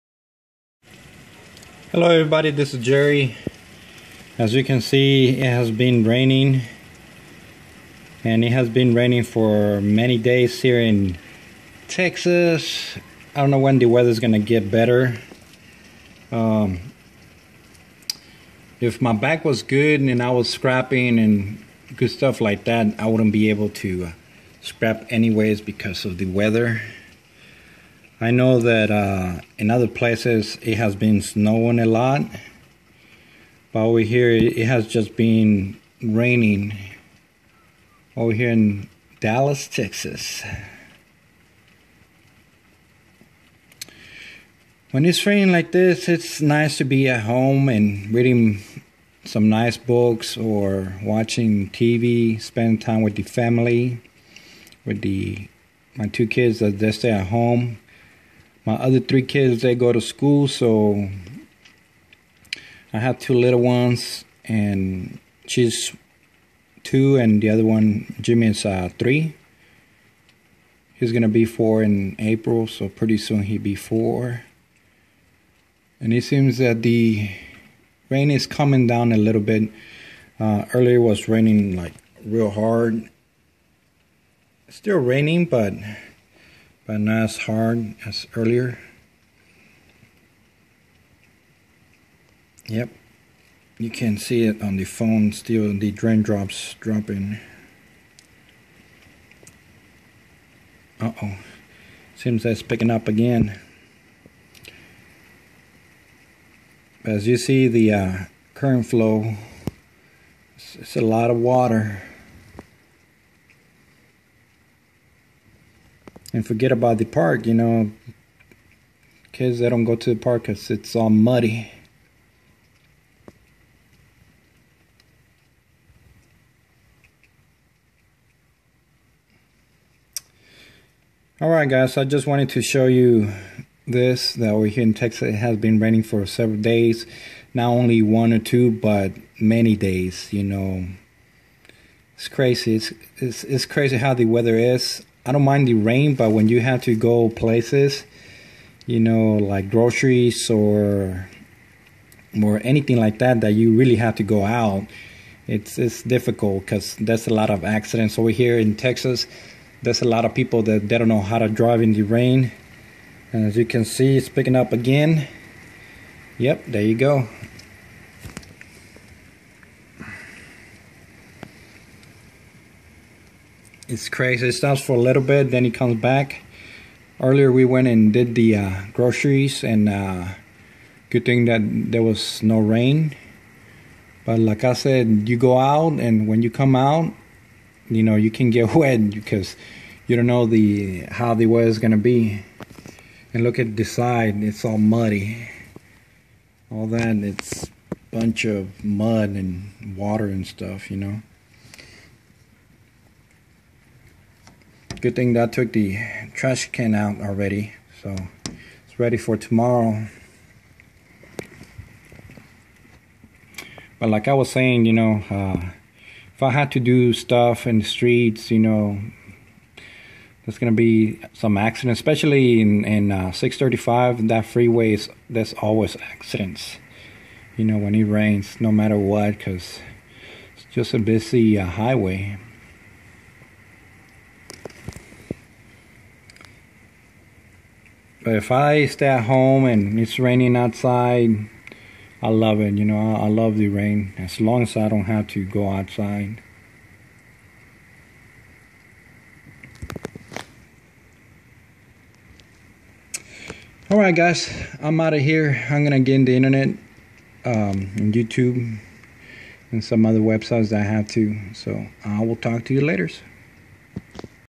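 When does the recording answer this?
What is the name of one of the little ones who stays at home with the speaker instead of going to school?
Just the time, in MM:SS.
01:08.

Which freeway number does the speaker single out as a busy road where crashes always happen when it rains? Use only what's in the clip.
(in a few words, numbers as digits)
635.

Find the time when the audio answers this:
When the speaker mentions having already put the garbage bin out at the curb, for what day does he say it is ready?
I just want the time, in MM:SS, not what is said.
03:29.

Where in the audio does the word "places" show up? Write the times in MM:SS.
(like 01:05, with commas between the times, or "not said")
00:29, 02:27.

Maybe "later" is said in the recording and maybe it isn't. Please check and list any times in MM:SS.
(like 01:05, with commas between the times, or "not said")
04:22.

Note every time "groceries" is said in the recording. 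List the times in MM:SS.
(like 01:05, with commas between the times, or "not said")
02:29, 02:58.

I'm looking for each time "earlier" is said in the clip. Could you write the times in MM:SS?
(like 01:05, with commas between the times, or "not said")
01:20, 01:28, 02:57.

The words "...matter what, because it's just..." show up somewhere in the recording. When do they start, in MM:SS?
03:48.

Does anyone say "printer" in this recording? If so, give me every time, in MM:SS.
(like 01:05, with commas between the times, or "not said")
not said.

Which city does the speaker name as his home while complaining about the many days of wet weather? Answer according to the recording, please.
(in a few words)
Dallas.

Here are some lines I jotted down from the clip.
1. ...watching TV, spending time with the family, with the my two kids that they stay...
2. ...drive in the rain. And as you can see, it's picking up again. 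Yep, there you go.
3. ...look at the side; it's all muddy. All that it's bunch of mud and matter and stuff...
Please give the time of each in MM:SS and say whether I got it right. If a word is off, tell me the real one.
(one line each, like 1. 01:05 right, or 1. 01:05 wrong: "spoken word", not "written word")
1. 00:51 right
2. 02:41 right
3. 03:13 wrong: "water", not "matter".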